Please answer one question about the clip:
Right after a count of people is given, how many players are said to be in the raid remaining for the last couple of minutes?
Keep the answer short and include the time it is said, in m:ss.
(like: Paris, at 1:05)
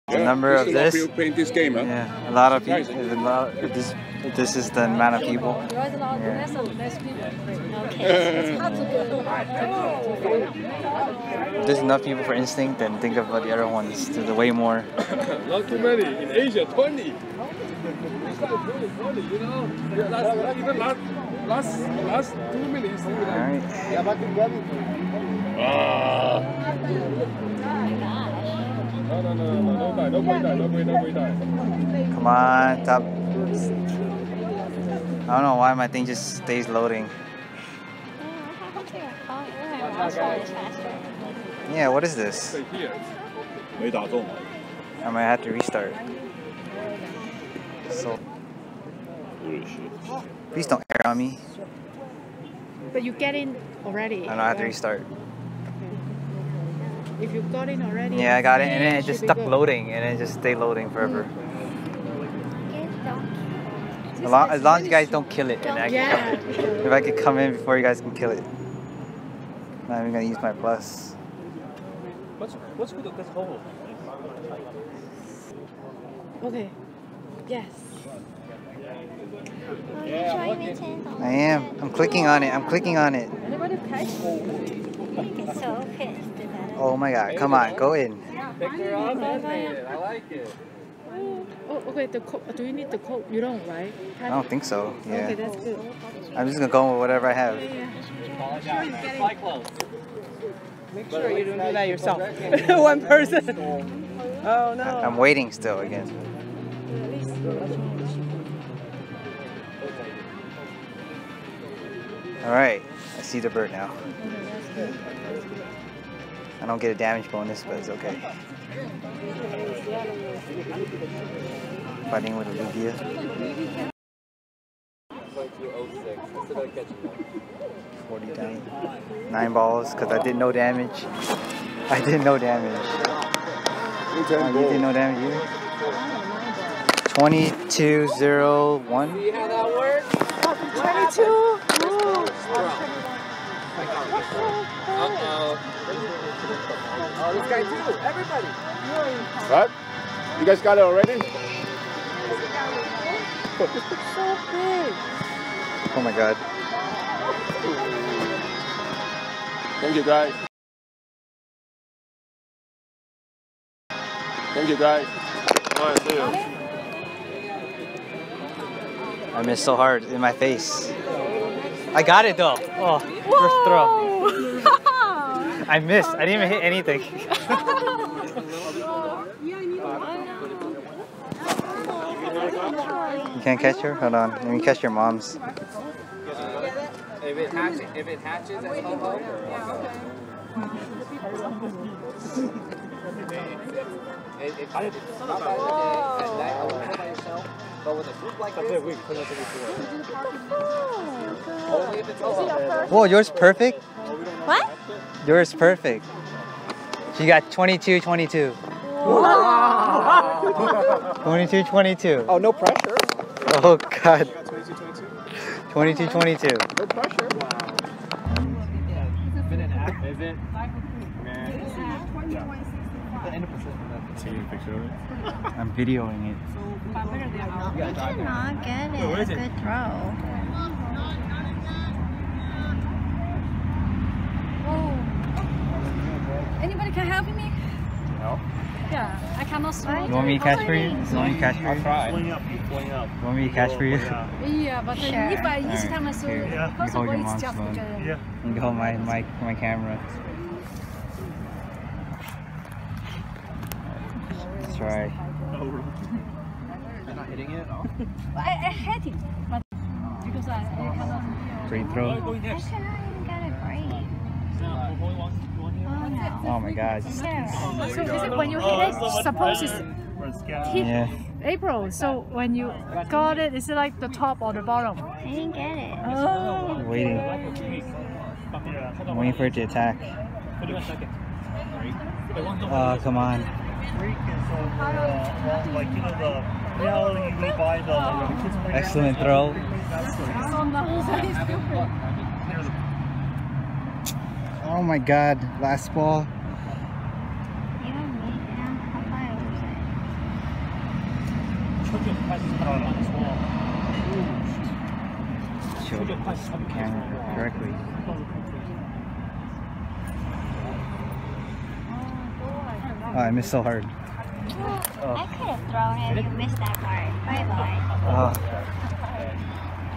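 20, at 0:16.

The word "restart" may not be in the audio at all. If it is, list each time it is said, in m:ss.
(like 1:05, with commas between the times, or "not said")
0:45, 0:54.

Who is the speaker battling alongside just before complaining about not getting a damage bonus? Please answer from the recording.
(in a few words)
Olivia.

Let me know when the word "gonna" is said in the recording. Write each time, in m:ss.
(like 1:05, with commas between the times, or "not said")
1:10, 1:36.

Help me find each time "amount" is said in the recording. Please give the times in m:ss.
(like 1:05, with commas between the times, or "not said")
0:04.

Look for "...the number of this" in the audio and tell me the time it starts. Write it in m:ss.
0:00.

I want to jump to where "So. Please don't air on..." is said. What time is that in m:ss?
0:47.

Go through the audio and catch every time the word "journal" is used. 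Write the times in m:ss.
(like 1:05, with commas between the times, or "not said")
not said.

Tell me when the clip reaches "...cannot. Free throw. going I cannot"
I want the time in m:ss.
4:20.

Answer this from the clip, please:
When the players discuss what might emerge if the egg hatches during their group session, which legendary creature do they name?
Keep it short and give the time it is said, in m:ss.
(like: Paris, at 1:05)
Ho-Oh, at 3:08.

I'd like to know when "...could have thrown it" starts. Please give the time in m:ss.
5:15.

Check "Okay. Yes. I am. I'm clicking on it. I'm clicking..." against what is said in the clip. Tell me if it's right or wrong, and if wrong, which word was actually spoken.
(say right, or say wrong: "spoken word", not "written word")
right.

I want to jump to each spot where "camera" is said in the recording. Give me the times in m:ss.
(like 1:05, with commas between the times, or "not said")
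4:09, 5:06.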